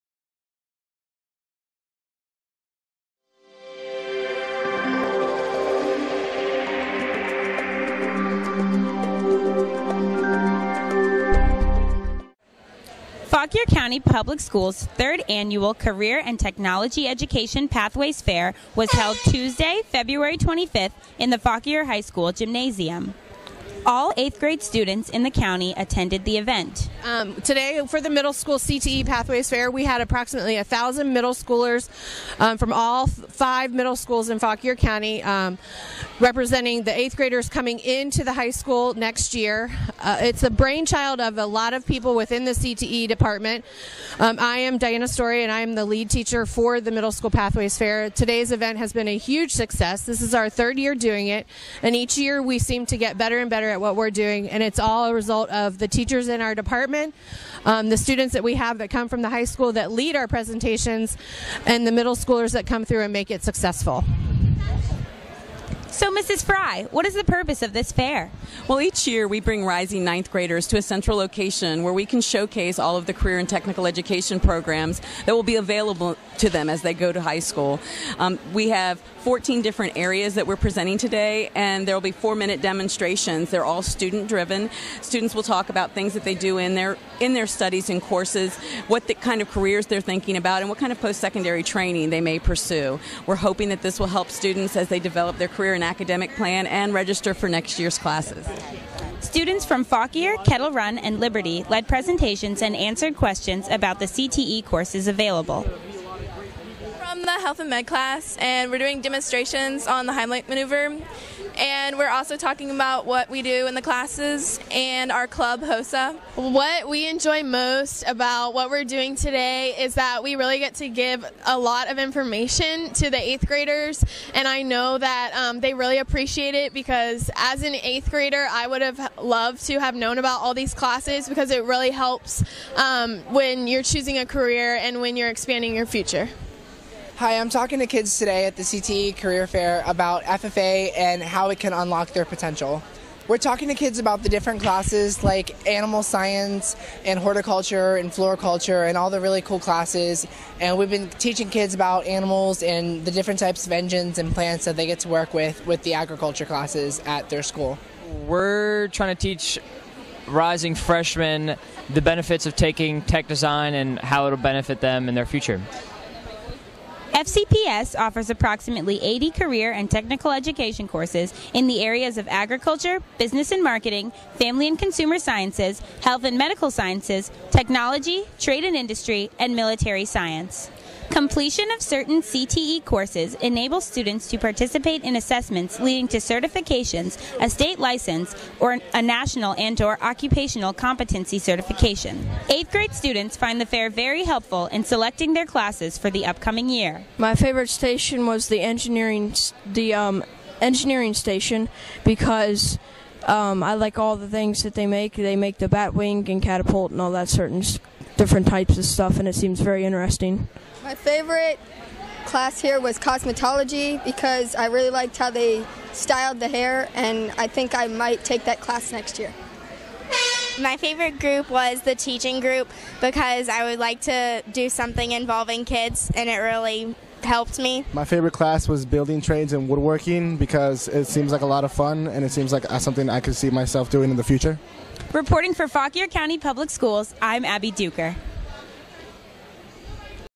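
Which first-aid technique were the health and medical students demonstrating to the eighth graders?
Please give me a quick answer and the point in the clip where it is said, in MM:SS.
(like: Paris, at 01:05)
Heimlich maneuver, at 01:50.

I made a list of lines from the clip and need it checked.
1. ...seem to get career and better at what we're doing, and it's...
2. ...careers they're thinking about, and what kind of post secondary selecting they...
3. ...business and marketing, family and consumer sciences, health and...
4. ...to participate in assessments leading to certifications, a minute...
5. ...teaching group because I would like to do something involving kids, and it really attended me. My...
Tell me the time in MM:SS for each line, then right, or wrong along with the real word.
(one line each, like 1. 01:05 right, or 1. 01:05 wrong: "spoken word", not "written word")
1. 00:52 wrong: "better", not "career"
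2. 01:29 wrong: "training", not "selecting"
3. 02:53 right
4. 03:04 wrong: "state", not "minute"
5. 03:41 wrong: "helped", not "attended".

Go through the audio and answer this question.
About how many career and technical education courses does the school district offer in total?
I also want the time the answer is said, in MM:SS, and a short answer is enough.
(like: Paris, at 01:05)
80, at 02:48.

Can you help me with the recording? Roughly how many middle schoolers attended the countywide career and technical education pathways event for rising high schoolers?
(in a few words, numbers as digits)
1000.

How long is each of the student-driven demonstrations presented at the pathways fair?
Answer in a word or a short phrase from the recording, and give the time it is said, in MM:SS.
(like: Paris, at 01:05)
4 minutes, at 01:22.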